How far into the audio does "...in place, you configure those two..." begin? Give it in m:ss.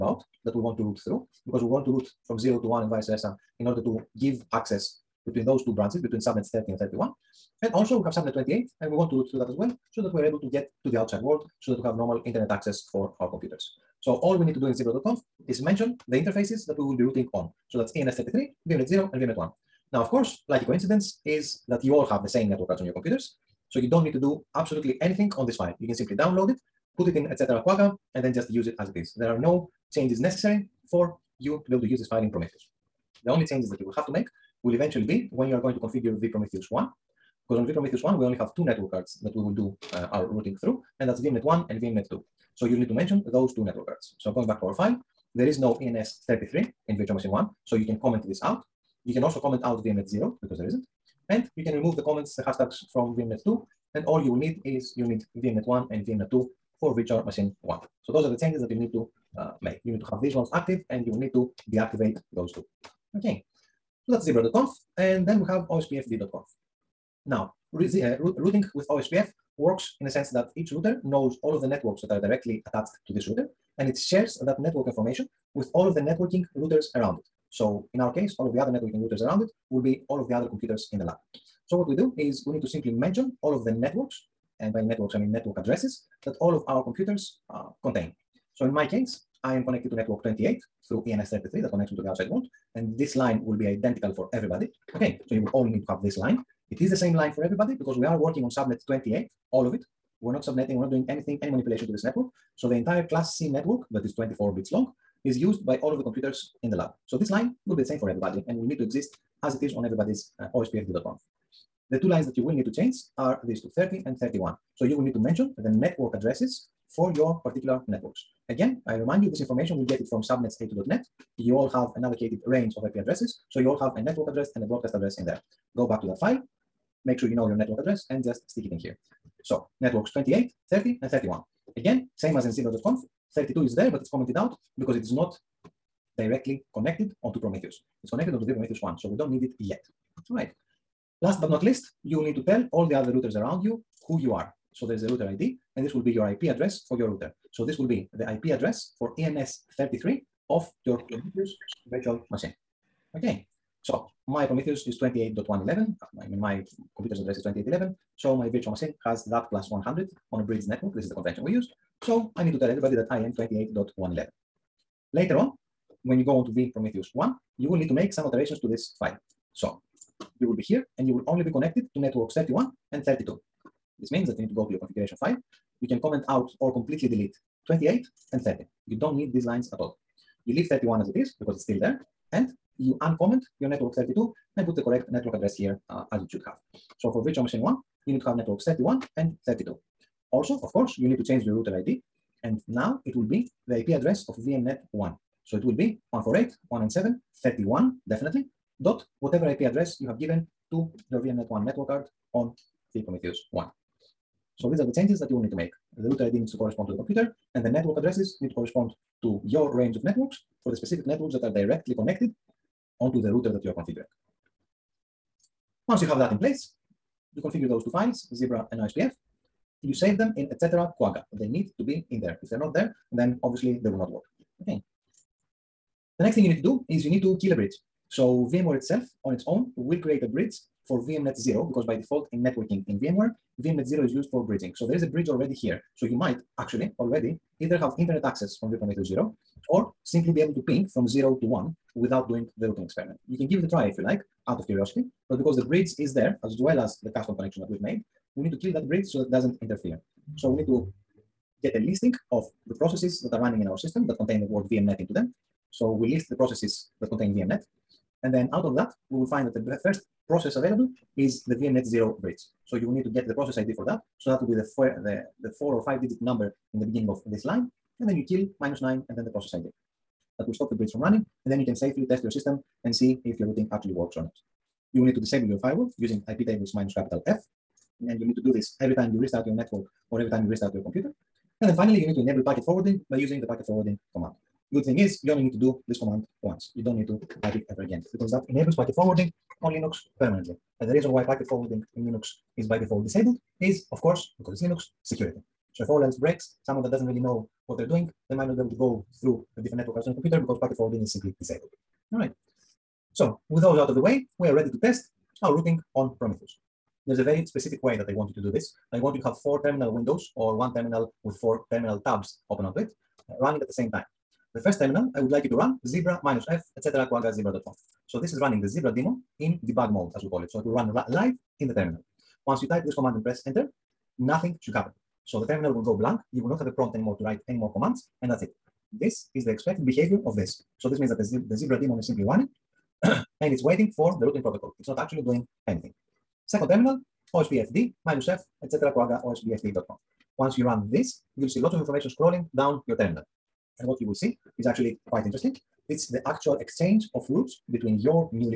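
3:36.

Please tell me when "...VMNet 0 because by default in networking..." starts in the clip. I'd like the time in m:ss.
3:51.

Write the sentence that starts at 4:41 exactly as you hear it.
And then finally, you need to enable packet forwarding by using the packet forwarding command.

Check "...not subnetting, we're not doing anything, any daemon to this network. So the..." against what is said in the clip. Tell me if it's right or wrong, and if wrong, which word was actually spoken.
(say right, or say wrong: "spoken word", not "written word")
wrong: "manipulation", not "daemon".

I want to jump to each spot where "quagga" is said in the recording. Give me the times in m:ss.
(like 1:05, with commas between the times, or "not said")
0:27, 3:40, 5:17, 5:38.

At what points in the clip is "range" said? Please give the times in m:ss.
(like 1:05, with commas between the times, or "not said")
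2:02, 3:29.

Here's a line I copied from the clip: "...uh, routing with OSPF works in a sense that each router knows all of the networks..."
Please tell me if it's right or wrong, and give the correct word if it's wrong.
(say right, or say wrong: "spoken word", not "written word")
right.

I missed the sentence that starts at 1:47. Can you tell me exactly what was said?
So this line will be the same for everybody and will need to exist as it is on everybody's uh, OSPFD.conf.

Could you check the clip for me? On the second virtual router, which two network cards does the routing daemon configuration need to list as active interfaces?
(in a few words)
VMNet 1 and VMNet 2.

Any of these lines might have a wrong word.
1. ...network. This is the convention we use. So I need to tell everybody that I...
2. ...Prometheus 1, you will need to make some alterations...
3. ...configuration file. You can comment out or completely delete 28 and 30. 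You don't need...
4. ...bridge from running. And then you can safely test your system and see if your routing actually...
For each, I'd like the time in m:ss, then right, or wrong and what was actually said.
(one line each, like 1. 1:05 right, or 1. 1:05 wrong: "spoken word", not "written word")
1. 2:40 right
2. 2:46 right
3. 2:54 right
4. 4:30 right.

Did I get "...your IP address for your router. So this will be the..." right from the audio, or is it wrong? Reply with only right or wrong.
right.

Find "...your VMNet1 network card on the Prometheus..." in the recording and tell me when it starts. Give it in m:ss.
3:21.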